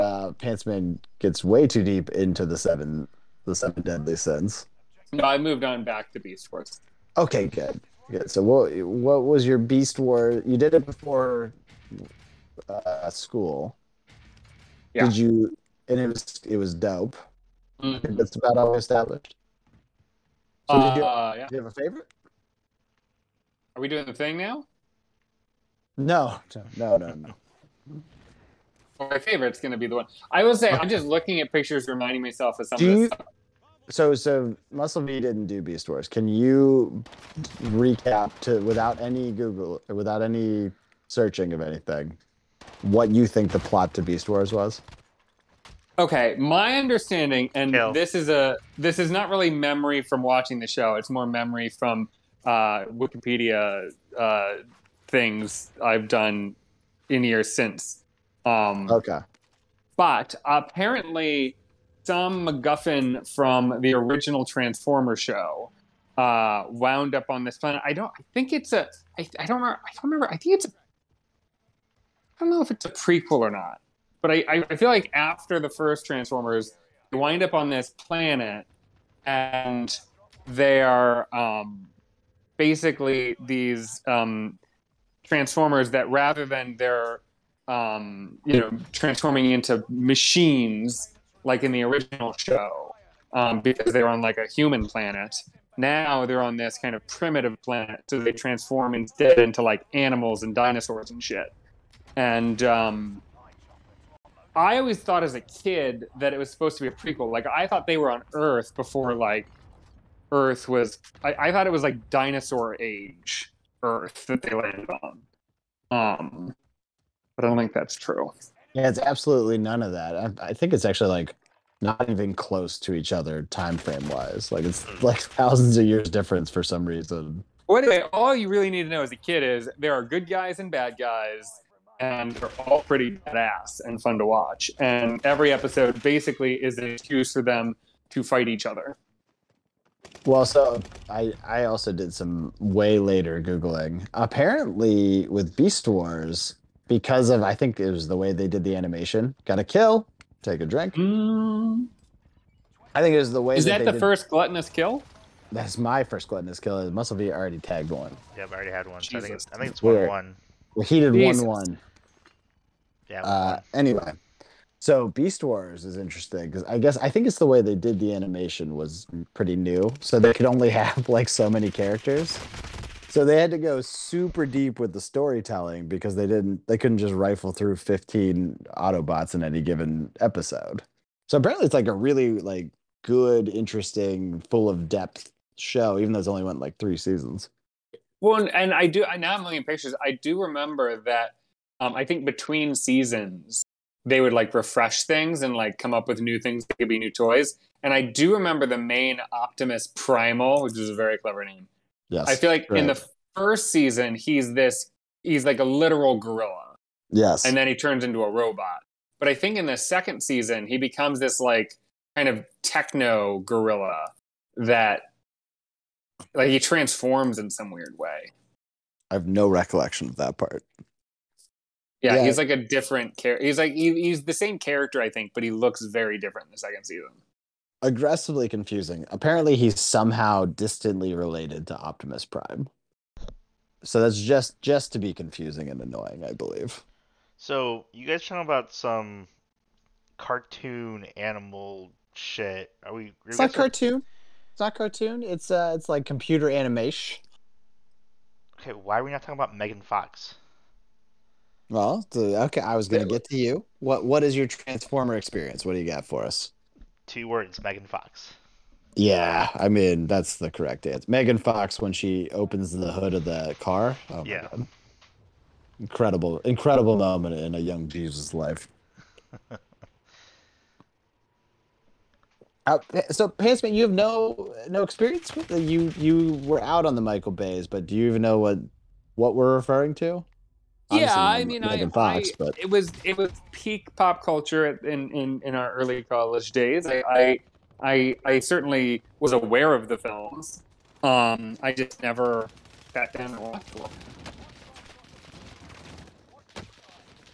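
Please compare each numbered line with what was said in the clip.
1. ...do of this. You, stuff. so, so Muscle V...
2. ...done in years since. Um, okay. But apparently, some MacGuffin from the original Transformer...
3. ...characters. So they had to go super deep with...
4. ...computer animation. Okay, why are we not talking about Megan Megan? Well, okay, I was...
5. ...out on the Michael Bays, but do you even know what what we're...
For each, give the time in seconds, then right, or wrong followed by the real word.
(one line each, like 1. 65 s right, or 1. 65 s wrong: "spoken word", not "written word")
1. 32 s right
2. 56 s right
3. 171 s right
4. 246 s wrong: "Fox", not "Megan"
5. 276 s right.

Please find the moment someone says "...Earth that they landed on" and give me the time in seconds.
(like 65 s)
113 s.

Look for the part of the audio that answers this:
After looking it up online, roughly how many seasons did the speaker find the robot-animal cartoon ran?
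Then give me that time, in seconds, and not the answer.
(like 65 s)
186 s.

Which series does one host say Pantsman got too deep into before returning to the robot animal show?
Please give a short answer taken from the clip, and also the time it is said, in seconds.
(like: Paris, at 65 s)
The Seven Deadly Sins, at 3 s.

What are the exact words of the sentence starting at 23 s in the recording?
Are we doing the thing now?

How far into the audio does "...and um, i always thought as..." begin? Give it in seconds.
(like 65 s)
102 s.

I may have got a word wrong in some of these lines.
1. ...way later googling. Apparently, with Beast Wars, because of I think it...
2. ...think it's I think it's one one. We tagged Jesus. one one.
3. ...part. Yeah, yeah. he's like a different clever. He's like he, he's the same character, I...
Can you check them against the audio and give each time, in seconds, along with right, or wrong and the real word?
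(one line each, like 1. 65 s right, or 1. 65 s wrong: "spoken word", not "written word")
1. 142 s right
2. 159 s wrong: "heated", not "tagged"
3. 220 s wrong: "character", not "clever".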